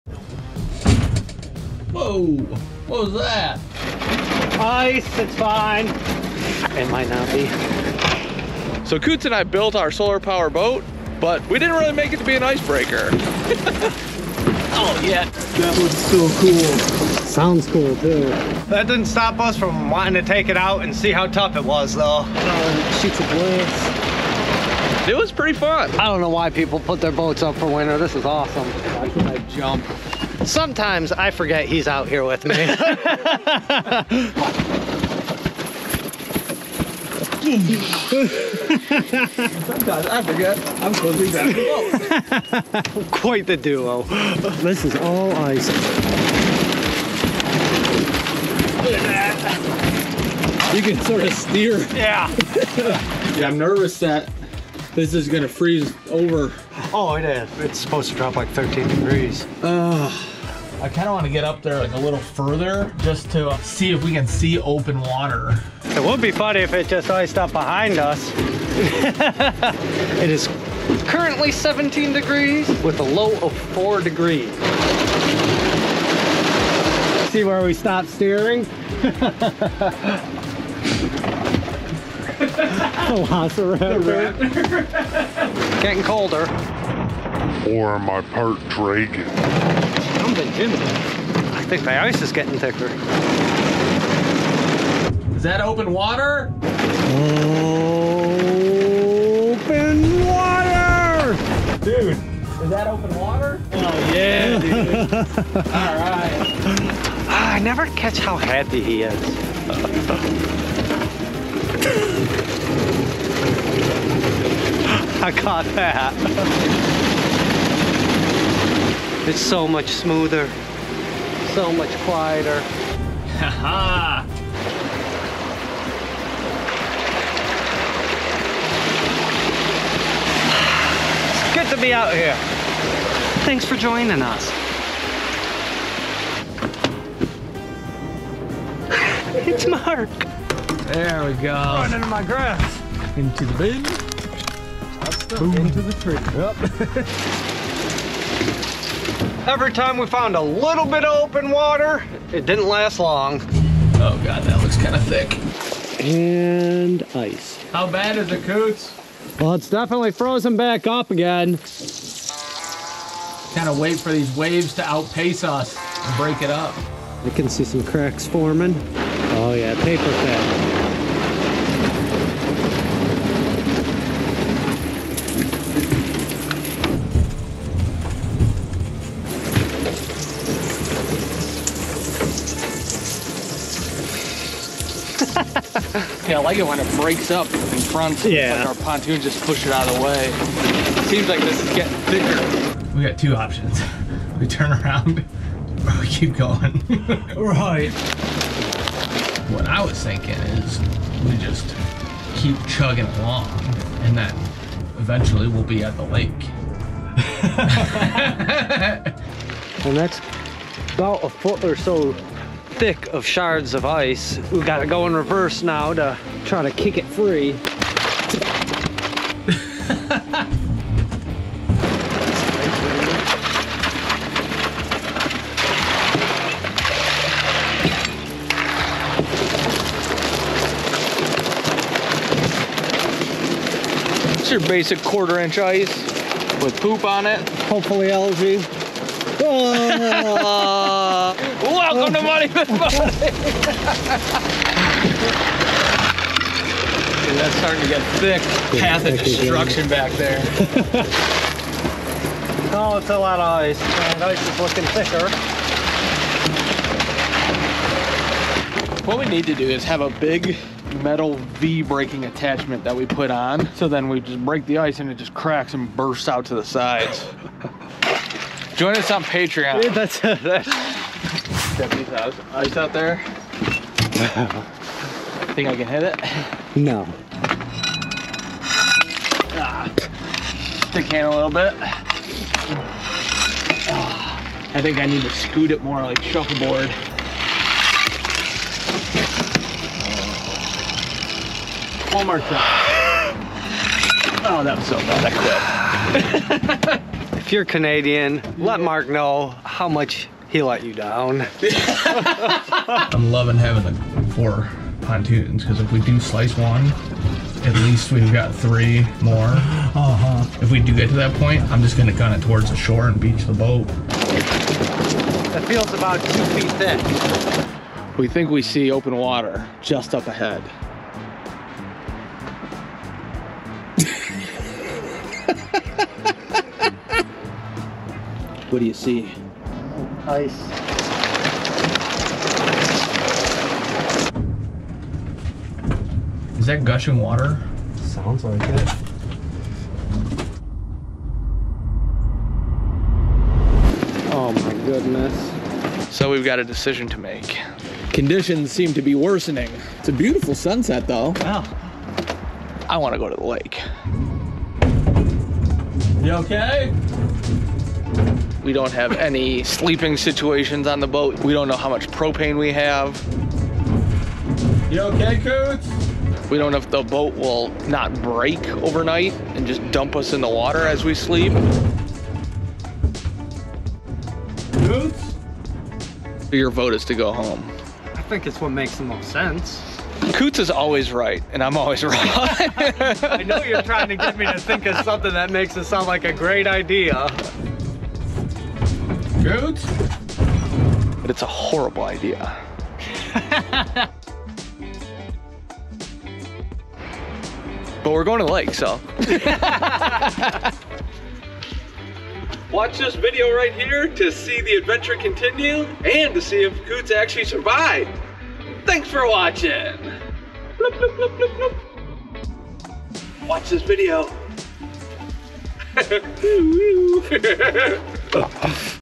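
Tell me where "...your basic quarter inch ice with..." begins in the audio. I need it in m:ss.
3:54.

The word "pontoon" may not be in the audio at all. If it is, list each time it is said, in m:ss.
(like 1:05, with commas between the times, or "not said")
3:08, 5:05.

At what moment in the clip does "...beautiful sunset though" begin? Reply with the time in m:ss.
5:50.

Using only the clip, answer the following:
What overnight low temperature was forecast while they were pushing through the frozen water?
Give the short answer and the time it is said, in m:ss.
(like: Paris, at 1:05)
4 degrees, at 1:13.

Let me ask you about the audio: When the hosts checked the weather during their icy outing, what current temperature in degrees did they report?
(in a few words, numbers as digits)
17 degrees.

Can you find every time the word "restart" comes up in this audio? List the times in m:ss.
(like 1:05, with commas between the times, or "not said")
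not said.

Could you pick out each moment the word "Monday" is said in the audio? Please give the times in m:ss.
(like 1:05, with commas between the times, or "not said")
4:02.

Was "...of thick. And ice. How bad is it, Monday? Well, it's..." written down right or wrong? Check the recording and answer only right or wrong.
wrong.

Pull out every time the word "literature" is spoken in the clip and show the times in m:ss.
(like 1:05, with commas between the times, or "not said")
not said.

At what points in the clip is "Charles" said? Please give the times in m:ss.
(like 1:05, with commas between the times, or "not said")
not said.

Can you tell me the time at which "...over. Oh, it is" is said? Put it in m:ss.
0:56.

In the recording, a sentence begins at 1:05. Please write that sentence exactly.
It would be funny if it just iced up behind us.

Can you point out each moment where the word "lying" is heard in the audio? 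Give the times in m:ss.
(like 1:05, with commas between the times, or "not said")
not said.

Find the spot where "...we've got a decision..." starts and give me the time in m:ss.
5:46.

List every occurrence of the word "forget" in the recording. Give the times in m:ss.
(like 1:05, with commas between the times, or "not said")
0:31, 0:40.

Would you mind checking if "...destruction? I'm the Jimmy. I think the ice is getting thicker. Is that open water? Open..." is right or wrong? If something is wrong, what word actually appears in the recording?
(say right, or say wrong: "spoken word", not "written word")
wrong: "dragon", not "destruction".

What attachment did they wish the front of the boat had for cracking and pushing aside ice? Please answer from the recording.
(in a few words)
metal V-braking attachment.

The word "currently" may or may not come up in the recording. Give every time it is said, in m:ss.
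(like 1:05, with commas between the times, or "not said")
1:11.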